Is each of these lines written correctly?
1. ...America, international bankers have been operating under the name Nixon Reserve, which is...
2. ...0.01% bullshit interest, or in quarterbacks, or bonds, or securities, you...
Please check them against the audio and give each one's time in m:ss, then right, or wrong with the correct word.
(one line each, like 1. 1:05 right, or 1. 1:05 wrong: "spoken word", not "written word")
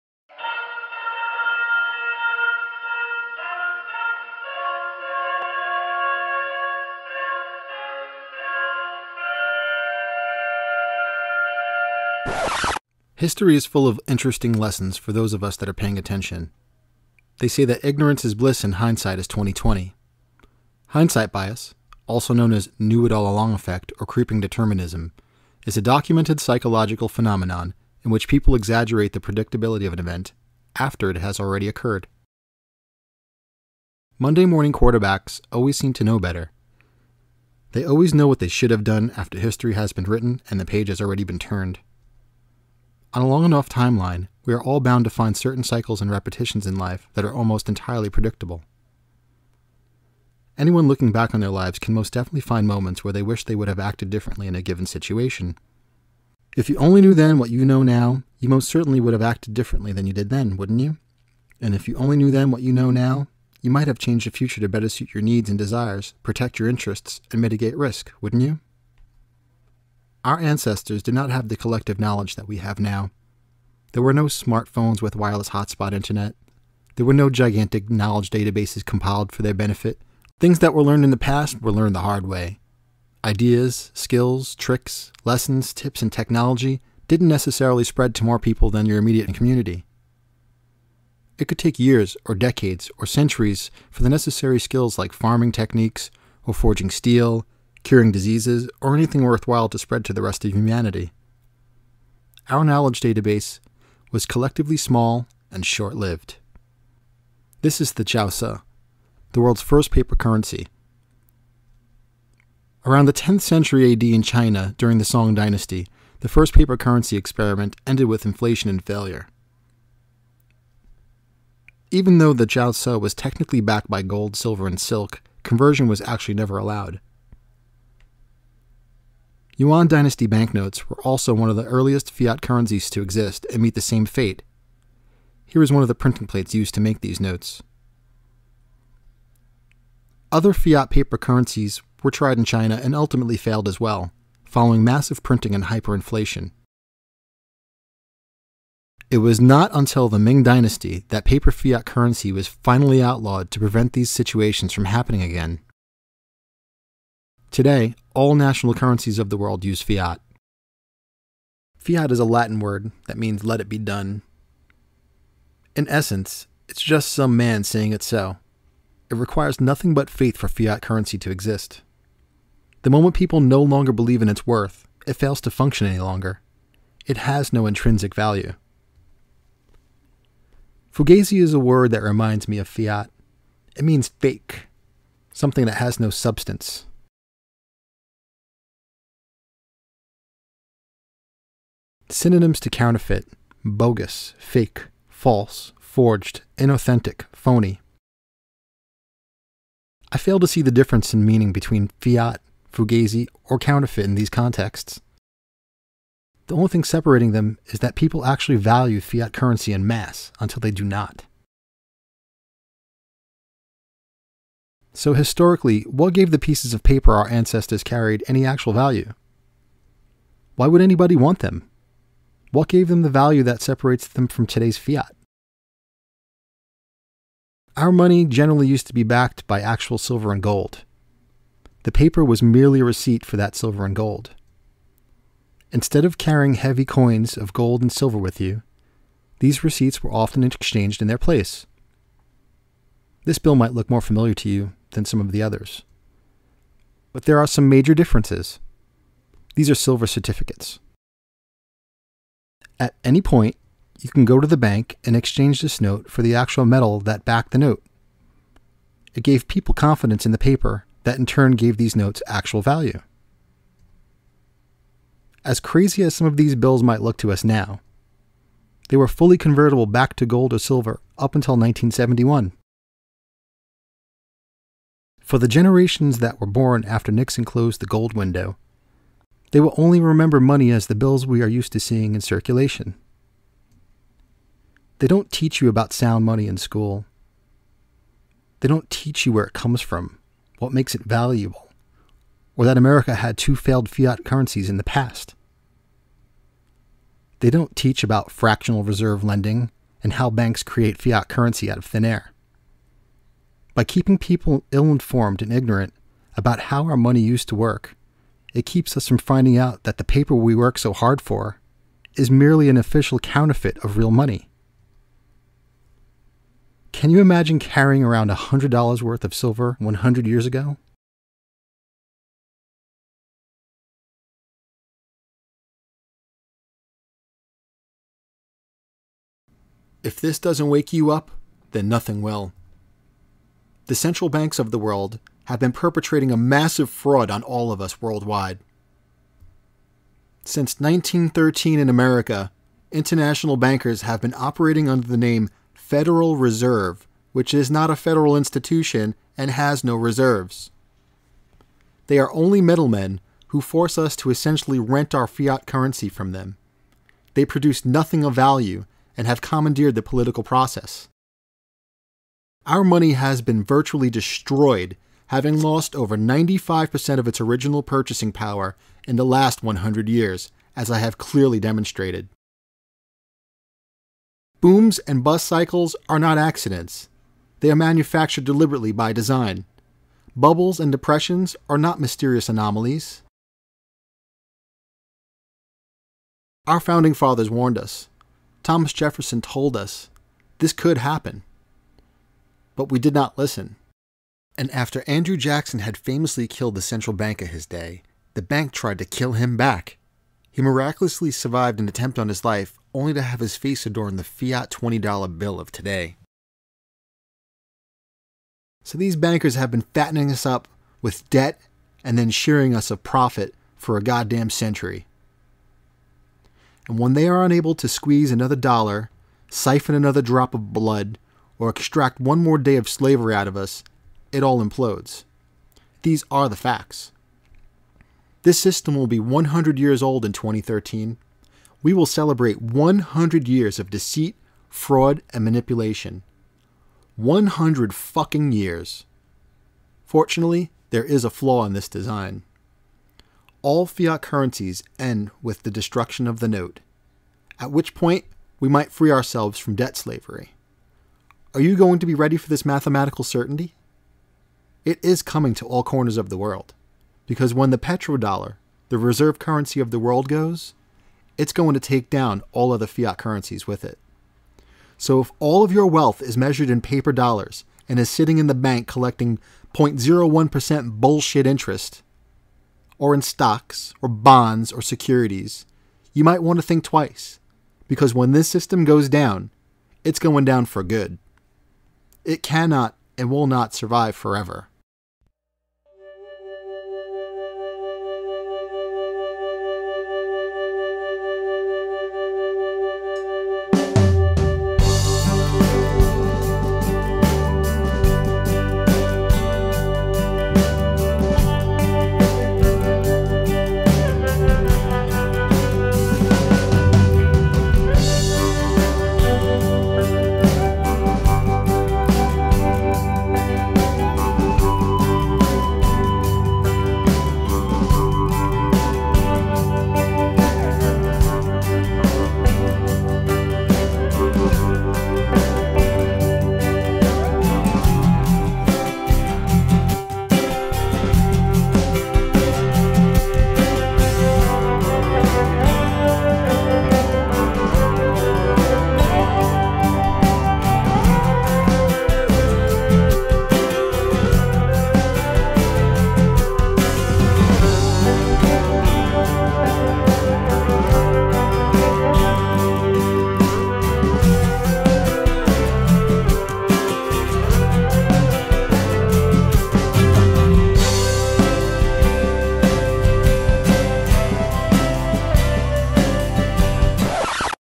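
1. 5:41 wrong: "Federal", not "Nixon"
2. 7:49 wrong: "stocks", not "quarterbacks".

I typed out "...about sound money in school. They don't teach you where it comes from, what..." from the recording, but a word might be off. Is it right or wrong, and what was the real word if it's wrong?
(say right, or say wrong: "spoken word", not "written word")
right.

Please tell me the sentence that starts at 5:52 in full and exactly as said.
They are only middlemen who force us to essentially rent our fiat currency from them.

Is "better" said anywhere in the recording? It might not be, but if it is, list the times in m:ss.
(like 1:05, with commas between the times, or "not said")
0:36, 1:04.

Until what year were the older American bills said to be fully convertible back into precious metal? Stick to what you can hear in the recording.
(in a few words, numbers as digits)
1971.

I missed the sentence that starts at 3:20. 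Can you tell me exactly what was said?
I fail to see the difference in meaning between fiat, fugazi, or counterfeit in these contexts.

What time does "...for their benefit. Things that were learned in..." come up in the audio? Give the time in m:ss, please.
1:19.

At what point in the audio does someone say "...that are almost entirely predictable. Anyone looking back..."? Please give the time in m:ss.
0:47.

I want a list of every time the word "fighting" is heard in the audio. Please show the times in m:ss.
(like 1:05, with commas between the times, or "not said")
not said.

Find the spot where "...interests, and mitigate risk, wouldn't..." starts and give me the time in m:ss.
1:06.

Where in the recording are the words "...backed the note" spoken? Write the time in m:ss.
4:17.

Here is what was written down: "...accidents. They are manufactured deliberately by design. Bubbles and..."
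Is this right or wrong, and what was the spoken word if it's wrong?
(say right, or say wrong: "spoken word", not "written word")
right.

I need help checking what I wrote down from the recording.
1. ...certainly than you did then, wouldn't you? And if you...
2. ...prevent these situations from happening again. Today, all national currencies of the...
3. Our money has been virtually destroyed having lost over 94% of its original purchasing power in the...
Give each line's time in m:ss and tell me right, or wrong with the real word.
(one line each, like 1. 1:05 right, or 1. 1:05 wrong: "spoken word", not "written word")
1. 0:59 wrong: "differently", not "certainly"
2. 2:33 right
3. 6:02 wrong: "95", not "94".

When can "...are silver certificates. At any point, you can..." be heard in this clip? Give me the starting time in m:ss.
4:09.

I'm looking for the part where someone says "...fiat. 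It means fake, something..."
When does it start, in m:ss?
3:02.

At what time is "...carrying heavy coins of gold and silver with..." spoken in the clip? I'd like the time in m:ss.
3:56.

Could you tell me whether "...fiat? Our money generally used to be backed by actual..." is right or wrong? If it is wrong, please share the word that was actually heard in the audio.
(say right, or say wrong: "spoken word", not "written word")
right.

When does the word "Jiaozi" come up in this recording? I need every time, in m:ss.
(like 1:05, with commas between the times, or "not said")
1:48, 2:02.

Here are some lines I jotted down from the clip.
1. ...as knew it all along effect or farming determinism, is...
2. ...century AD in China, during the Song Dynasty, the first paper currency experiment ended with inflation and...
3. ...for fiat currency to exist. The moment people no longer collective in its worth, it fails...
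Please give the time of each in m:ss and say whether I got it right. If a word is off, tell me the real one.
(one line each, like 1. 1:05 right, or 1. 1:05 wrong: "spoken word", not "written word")
1. 0:22 wrong: "creeping", not "farming"
2. 1:53 right
3. 2:50 wrong: "believe", not "collective".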